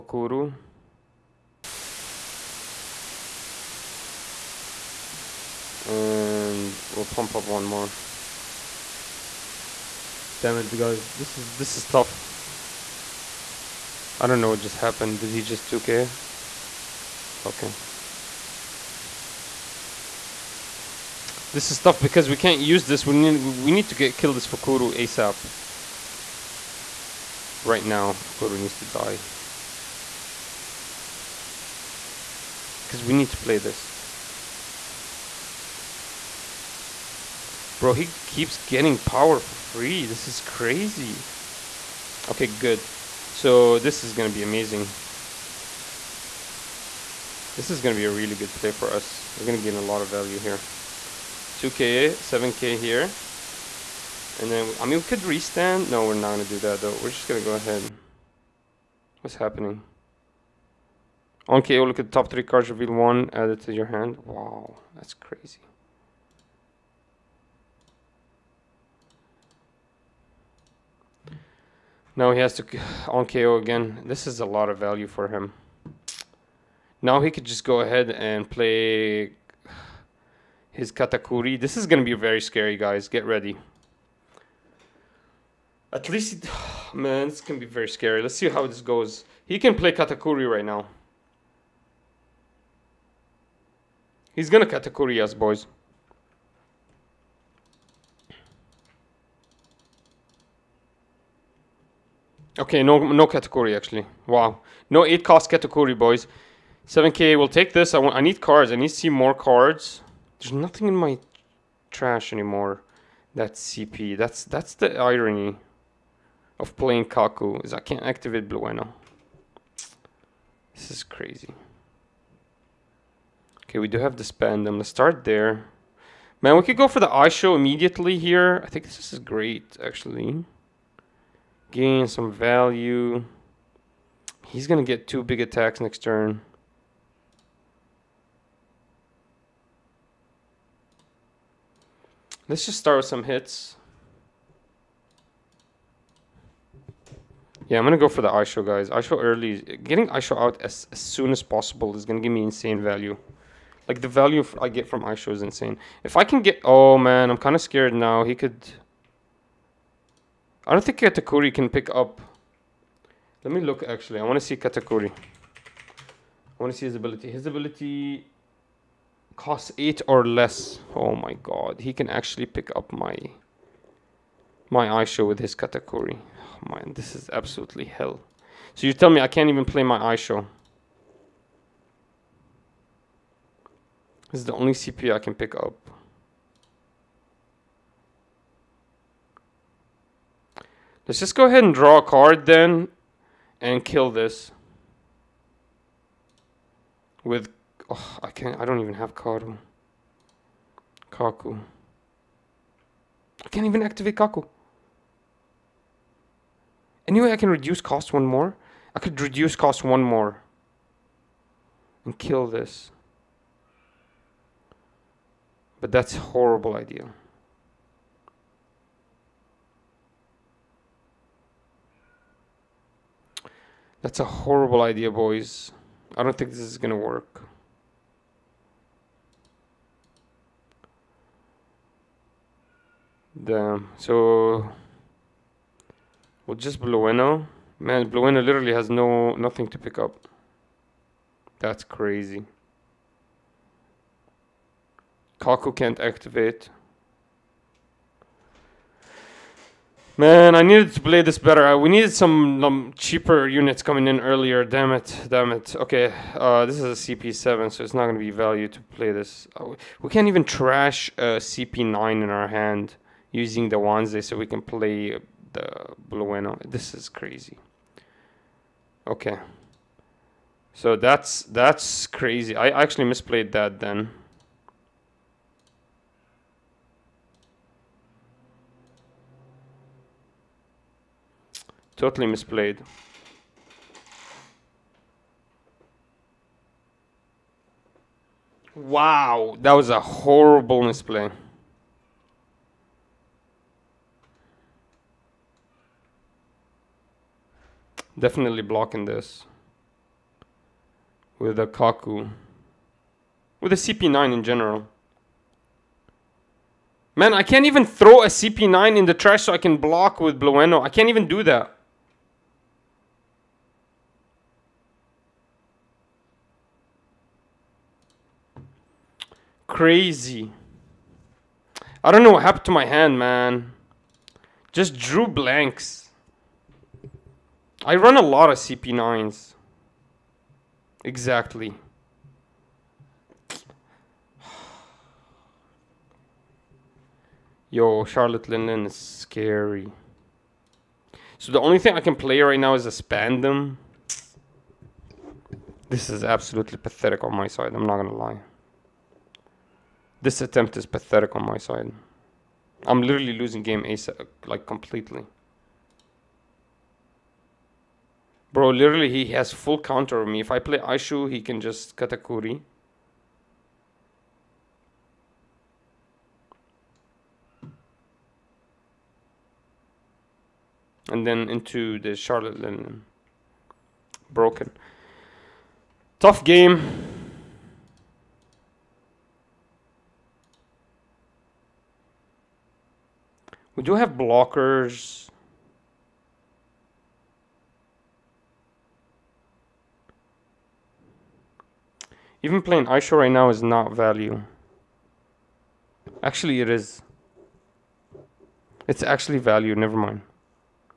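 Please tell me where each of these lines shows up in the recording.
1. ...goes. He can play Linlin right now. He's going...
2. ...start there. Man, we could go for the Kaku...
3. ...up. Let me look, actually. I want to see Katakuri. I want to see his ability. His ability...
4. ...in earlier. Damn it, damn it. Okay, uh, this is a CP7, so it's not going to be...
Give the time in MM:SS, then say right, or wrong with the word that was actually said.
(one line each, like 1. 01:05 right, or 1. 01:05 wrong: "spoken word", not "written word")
1. 01:28 wrong: "Katakuri", not "Linlin"
2. 02:04 wrong: "Issho", not "Kaku"
3. 02:41 right
4. 04:14 right.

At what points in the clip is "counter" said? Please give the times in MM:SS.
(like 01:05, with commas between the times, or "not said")
05:59.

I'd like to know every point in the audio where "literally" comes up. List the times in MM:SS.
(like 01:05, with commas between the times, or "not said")
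03:58, 05:53, 05:58.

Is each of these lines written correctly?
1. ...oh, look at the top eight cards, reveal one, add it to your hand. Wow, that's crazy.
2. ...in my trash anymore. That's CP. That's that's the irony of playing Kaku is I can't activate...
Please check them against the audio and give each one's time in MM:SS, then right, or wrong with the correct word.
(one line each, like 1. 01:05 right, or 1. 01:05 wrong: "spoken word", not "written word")
1. 01:01 wrong: "three", not "eight"
2. 01:50 right.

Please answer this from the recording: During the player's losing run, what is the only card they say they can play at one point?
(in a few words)
Spandam.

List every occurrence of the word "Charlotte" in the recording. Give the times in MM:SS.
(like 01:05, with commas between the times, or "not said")
05:38, 06:12.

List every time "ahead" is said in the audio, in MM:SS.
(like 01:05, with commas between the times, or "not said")
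00:57, 01:17, 03:11.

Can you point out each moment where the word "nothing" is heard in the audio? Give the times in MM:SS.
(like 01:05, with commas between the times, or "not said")
01:50, 03:59.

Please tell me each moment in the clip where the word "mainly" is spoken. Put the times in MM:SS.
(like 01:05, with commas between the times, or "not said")
not said.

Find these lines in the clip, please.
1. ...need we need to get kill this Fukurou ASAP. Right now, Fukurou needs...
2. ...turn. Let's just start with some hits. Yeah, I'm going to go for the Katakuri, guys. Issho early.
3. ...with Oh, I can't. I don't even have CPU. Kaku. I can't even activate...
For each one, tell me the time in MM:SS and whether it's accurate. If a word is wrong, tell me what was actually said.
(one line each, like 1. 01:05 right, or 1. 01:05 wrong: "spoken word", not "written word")
1. 00:23 right
2. 02:15 wrong: "Issho", not "Katakuri"
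3. 03:17 wrong: "Karu", not "CPU".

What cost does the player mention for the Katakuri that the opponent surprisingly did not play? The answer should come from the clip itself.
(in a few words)
8.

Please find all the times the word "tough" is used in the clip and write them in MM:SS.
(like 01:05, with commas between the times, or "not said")
00:11, 00:21, 06:16.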